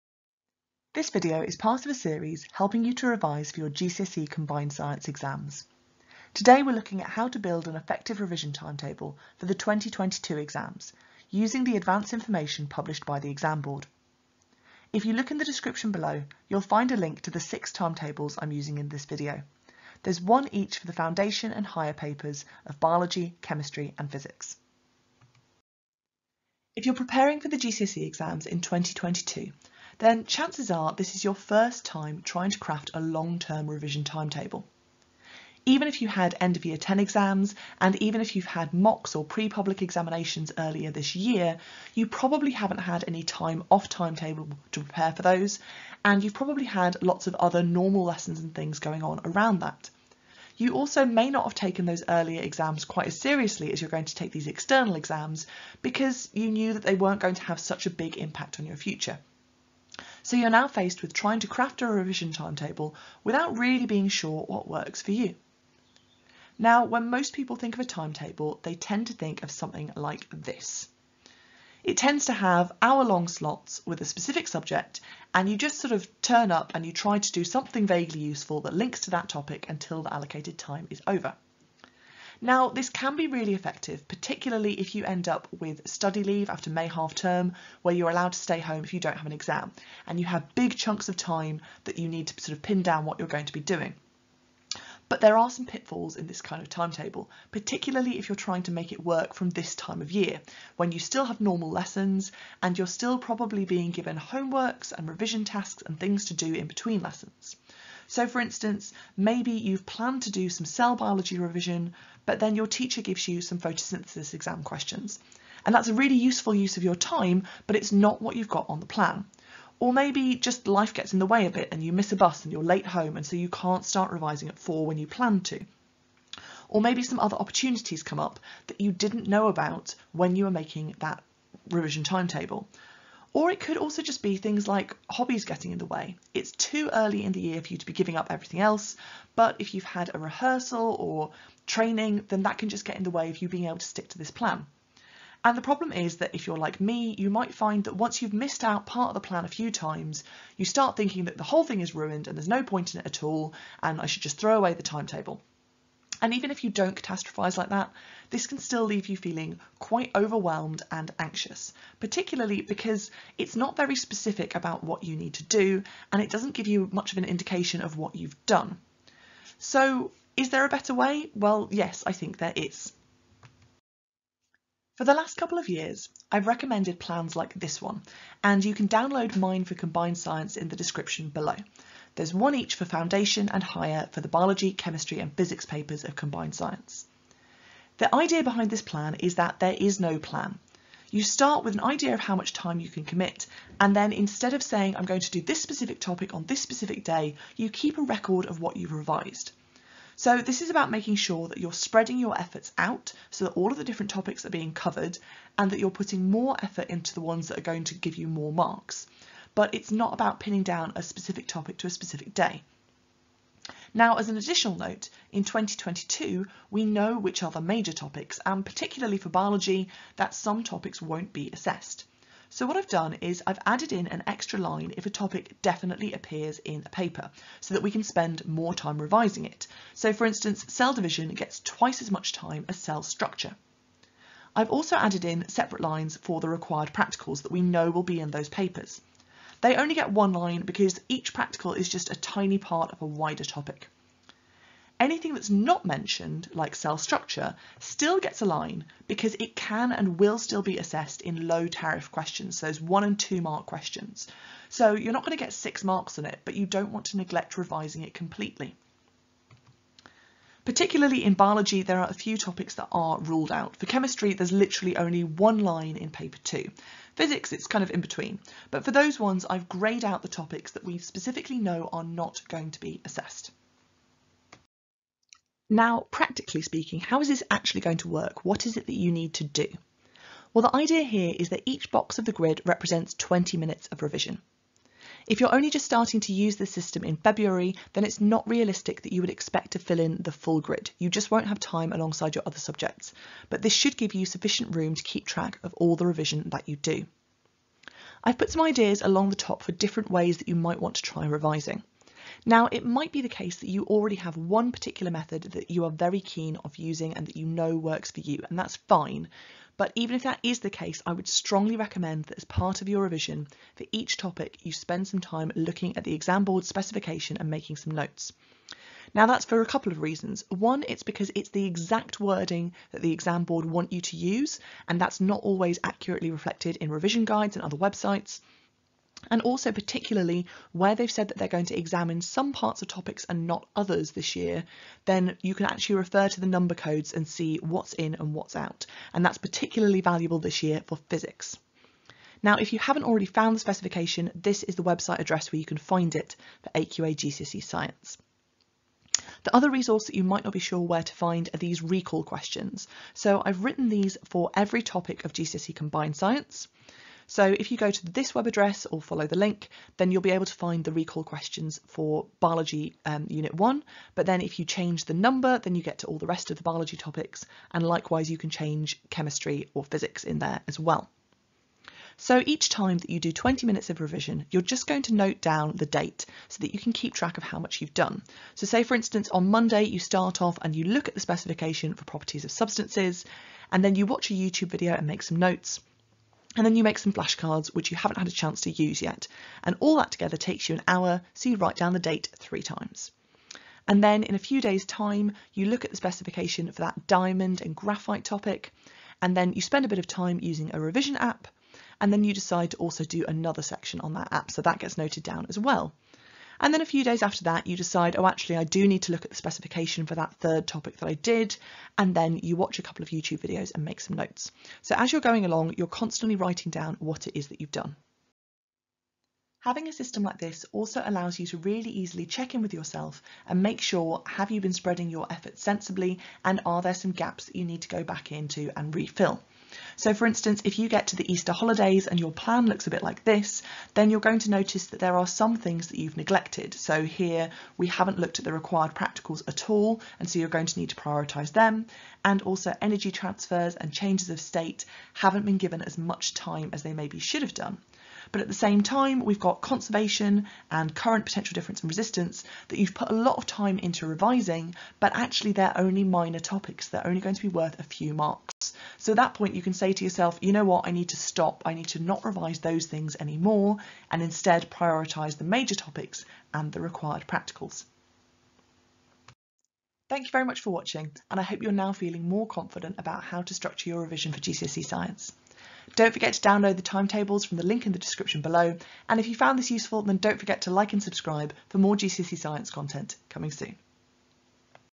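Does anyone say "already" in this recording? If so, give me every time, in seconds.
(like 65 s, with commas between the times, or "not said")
303 s, 343 s.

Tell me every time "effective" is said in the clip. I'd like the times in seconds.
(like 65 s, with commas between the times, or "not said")
7 s, 83 s.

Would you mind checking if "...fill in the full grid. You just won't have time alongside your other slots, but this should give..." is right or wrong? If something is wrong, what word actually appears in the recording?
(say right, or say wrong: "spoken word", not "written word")
wrong: "subjects", not "slots".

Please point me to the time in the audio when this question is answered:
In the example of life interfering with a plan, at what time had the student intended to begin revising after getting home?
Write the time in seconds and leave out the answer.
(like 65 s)
124 s.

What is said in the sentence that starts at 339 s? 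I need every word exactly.
And that's particularly valuable this year for physics.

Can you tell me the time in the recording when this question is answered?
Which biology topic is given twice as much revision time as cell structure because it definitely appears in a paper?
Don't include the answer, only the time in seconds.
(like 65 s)
230 s.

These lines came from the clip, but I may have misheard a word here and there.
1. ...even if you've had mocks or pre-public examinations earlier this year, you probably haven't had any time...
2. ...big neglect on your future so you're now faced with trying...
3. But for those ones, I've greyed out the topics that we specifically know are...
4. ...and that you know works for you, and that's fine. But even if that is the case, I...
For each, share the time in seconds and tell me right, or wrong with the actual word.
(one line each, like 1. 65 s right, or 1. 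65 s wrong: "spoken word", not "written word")
1. 38 s right
2. 57 s wrong: "impact", not "neglect"
3. 268 s right
4. 307 s right.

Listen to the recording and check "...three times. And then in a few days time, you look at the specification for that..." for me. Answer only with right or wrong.
right.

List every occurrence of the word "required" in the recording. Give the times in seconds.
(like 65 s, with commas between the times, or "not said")
236 s, 438 s, 466 s.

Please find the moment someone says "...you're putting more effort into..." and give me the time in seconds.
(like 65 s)
205 s.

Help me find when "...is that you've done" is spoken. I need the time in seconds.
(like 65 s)
417 s.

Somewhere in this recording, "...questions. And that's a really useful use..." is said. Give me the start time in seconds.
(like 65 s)
114 s.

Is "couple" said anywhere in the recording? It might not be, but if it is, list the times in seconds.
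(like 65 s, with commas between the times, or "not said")
175 s, 319 s, 412 s.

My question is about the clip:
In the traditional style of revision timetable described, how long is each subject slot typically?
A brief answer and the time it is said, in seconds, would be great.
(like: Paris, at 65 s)
hour-long, at 72 s.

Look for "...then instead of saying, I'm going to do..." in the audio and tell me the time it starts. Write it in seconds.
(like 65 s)
193 s.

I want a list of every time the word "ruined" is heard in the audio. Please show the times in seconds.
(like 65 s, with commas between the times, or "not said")
151 s.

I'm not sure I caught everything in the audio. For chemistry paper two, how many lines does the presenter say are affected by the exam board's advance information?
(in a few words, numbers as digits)
1.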